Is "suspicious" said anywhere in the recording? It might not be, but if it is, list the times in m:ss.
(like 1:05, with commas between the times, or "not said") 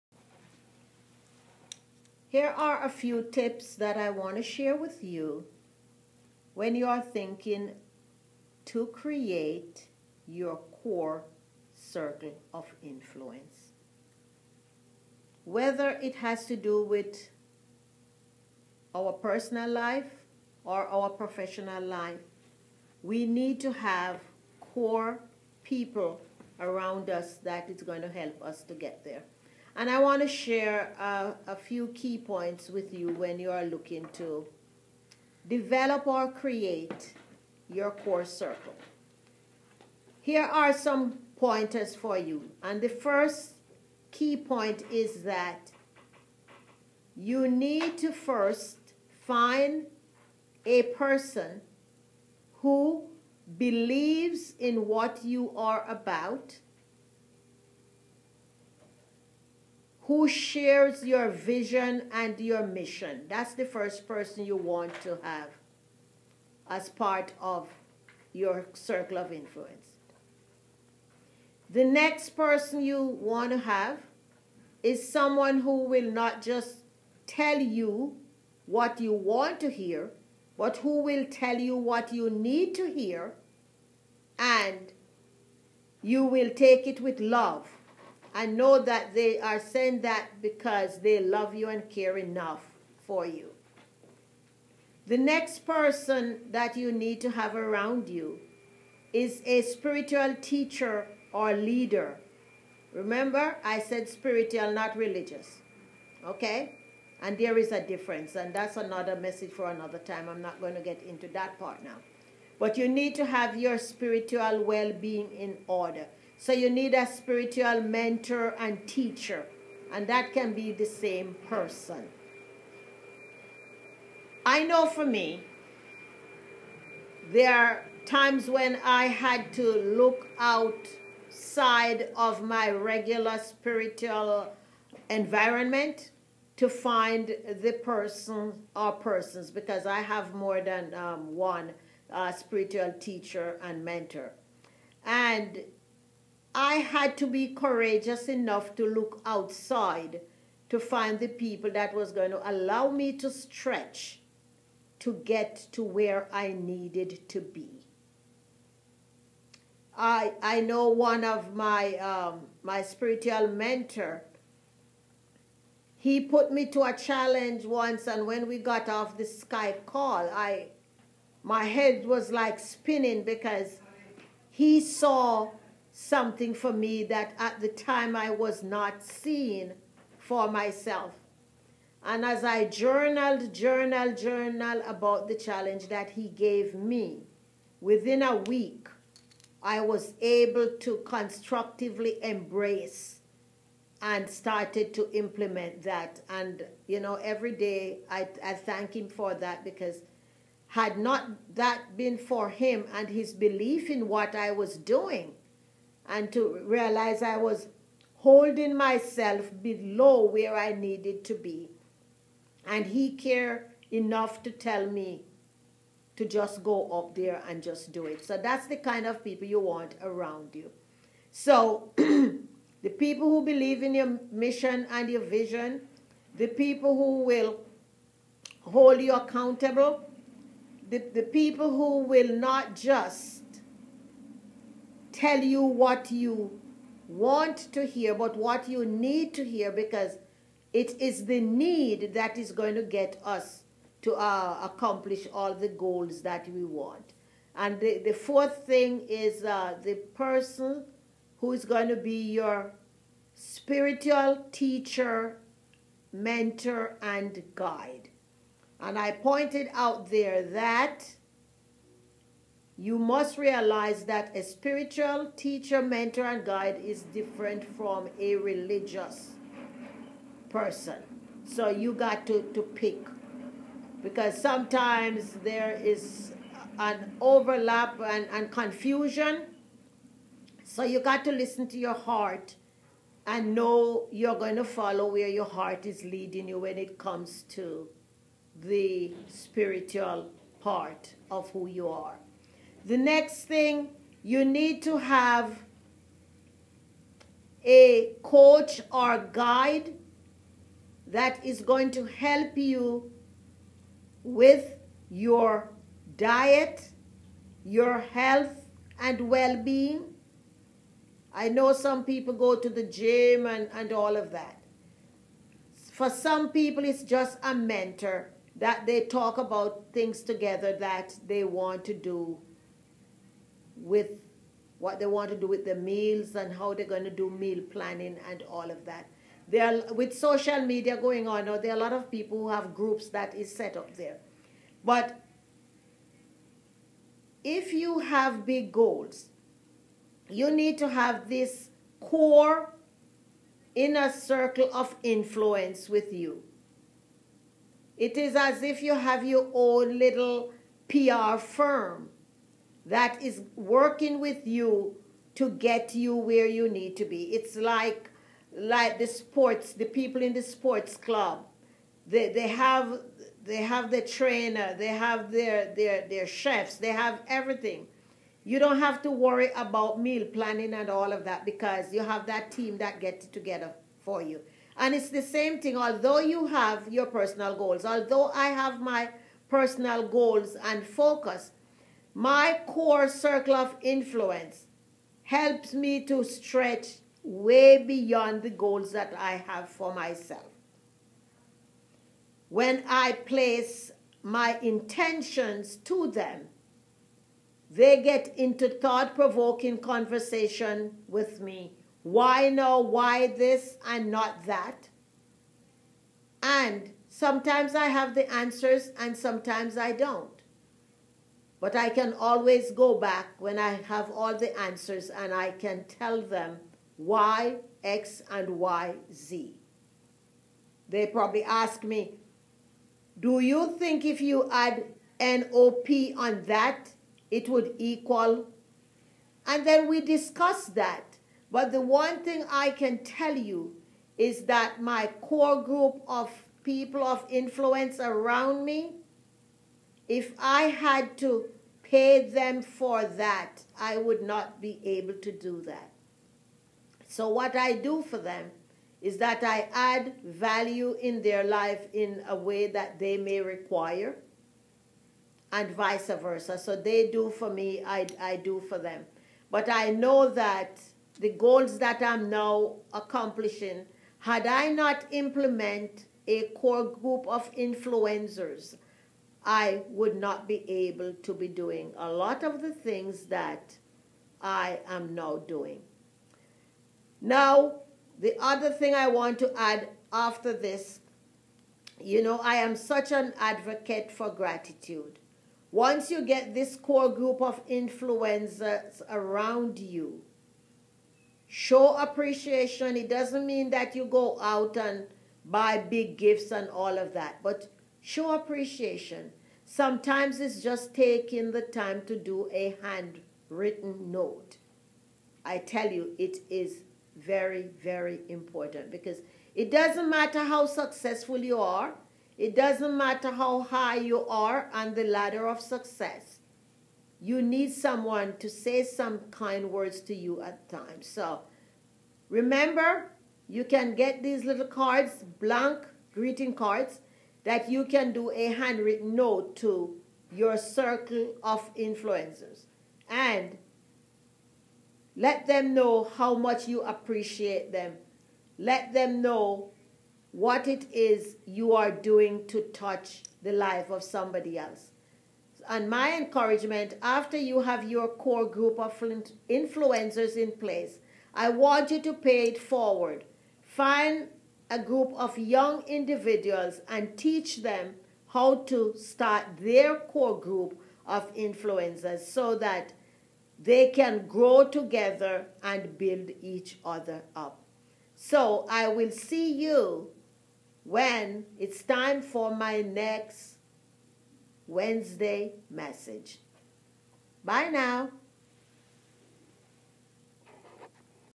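not said.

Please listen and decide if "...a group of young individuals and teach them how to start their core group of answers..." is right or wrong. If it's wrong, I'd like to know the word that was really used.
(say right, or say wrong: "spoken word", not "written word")
wrong: "influencers", not "answers".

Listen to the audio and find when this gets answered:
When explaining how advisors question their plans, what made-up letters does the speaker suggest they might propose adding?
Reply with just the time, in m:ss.
7:05.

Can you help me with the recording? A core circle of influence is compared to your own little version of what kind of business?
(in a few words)
PR firm.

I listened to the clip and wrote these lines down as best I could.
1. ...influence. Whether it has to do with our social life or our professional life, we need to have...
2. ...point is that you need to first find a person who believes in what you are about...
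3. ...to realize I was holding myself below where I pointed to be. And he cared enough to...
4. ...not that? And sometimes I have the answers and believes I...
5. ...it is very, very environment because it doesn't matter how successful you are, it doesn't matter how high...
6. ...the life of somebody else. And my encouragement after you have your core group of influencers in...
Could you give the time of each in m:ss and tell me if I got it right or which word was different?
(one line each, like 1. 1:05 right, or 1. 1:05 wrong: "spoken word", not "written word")
1. 0:12 wrong: "personal", not "social"
2. 0:44 right
3. 3:26 wrong: "needed", not "pointed"
4. 6:44 wrong: "sometimes", not "believes"
5. 8:26 wrong: "important", not "environment"
6. 9:03 right.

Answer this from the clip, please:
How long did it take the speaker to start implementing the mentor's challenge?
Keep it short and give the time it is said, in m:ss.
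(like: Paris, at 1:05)
a week, at 3:08.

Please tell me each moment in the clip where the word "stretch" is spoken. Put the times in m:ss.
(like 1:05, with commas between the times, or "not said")
2:33, 6:26.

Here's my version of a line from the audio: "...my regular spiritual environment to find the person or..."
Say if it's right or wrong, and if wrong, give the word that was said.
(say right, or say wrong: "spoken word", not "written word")
right.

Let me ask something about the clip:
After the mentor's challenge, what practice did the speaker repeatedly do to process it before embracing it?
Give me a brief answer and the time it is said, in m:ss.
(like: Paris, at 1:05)
journaled, at 3:02.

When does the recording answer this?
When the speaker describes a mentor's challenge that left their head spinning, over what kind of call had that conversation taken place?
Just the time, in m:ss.
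2:49.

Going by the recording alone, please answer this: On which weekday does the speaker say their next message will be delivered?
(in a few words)
Wednesday.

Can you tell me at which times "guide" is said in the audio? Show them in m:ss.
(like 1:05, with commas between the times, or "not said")
4:17, 4:26, 4:59.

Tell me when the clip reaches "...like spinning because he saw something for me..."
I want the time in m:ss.
2:52.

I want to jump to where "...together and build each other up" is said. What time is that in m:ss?
9:24.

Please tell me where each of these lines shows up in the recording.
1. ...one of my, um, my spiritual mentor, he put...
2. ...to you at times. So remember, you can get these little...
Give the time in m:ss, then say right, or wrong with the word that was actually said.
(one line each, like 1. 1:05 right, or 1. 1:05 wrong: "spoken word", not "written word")
1. 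2:40 right
2. 8:40 right.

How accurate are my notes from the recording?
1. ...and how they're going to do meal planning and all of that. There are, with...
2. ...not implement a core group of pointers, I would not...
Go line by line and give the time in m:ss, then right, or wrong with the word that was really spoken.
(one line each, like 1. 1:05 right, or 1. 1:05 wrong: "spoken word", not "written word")
1. 5:26 right
2. 7:44 wrong: "influencers", not "pointers".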